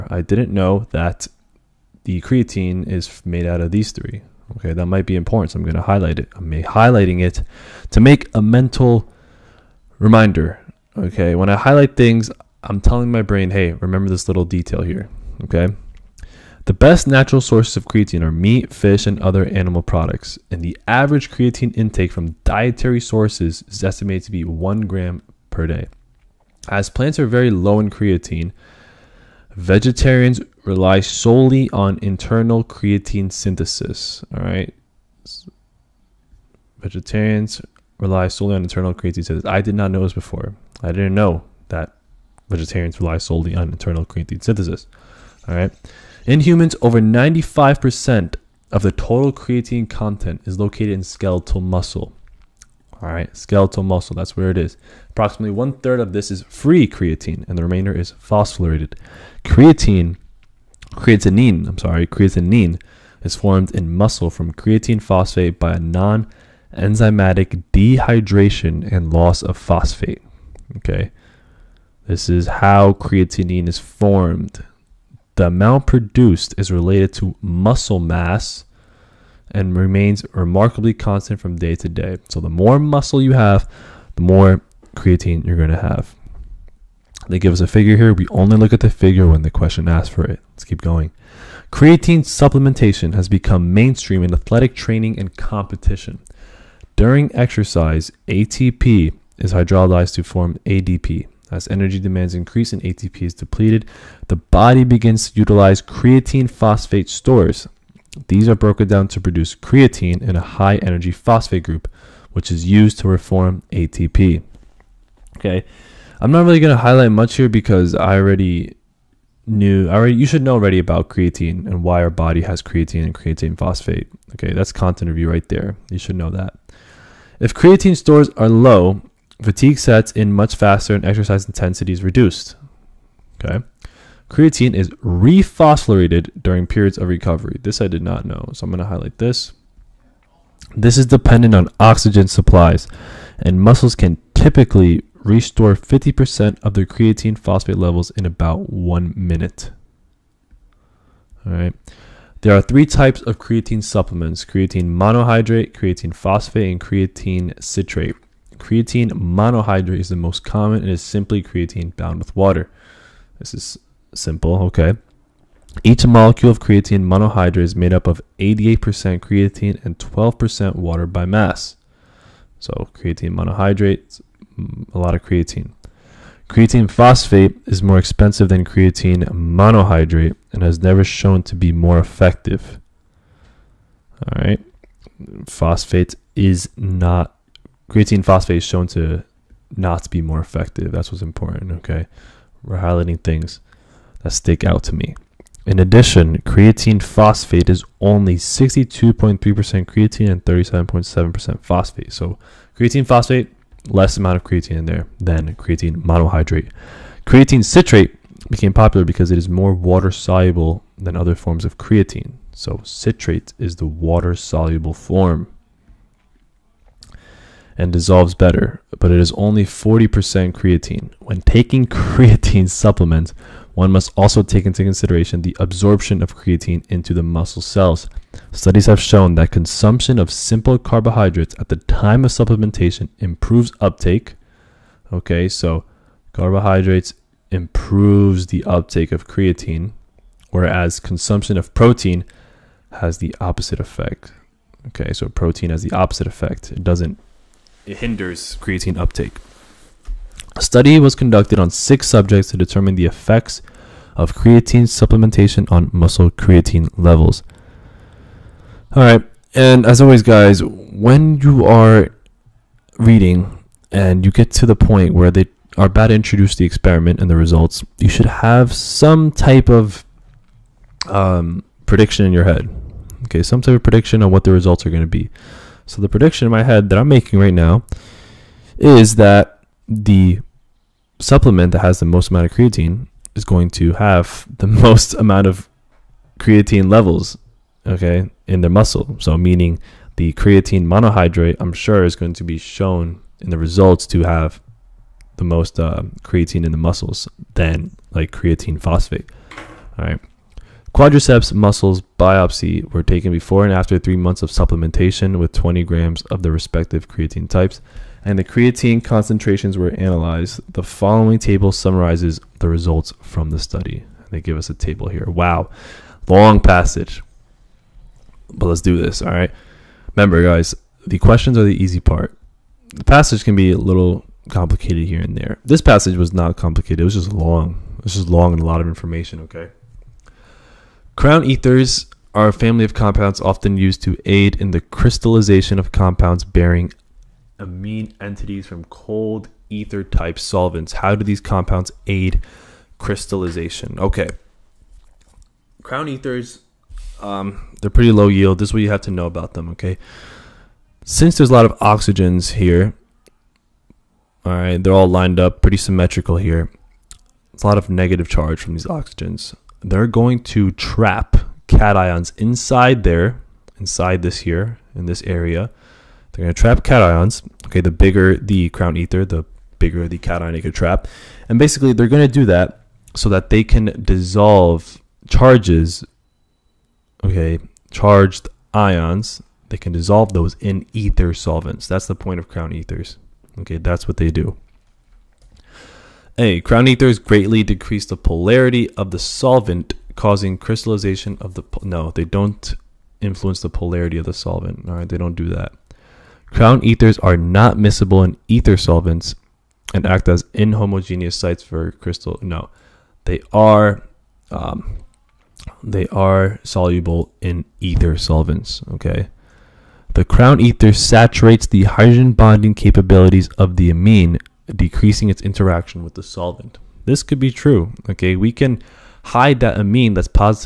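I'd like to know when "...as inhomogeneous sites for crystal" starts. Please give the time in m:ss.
6:40.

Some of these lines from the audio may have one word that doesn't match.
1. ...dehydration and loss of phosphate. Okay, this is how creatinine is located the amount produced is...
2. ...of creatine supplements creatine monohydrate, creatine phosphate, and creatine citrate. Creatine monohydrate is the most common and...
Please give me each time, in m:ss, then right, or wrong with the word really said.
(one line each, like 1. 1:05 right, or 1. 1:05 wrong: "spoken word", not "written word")
1. 1:07 wrong: "formed", not "located"
2. 2:33 right.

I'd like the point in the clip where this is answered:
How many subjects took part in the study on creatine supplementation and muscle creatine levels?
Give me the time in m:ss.
4:11.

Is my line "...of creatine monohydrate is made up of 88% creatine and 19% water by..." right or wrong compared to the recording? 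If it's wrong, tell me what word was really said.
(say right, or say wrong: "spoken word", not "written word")
wrong: "12", not "19".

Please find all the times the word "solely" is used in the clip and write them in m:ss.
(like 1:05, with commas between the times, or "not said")
0:31, 0:38, 0:43.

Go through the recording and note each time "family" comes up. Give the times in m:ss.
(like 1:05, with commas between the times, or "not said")
5:32.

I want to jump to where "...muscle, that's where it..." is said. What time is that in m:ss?
0:53.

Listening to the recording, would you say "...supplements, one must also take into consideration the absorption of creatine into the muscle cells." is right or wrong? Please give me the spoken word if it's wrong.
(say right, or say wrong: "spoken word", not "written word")
right.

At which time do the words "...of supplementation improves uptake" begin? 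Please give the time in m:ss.
3:52.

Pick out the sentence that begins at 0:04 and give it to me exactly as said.
Okay, that might be important, so I'm going to highlight it.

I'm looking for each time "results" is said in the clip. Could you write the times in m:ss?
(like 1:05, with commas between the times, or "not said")
4:27, 4:34, 4:53, 5:12.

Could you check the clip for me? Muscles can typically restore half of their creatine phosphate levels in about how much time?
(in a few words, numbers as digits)
one minute.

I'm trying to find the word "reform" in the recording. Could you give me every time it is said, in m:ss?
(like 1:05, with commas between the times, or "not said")
1:53.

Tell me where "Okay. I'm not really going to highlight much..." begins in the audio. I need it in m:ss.
1:55.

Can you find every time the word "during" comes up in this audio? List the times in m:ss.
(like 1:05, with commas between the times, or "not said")
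1:36, 2:16.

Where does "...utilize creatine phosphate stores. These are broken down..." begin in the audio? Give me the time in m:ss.
1:45.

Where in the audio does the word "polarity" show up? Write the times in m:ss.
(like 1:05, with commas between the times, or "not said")
6:28, 6:33.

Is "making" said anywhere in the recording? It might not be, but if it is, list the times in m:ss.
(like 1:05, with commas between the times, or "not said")
4:37.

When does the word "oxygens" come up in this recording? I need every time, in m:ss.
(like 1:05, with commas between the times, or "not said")
2:21, 5:51, 5:58.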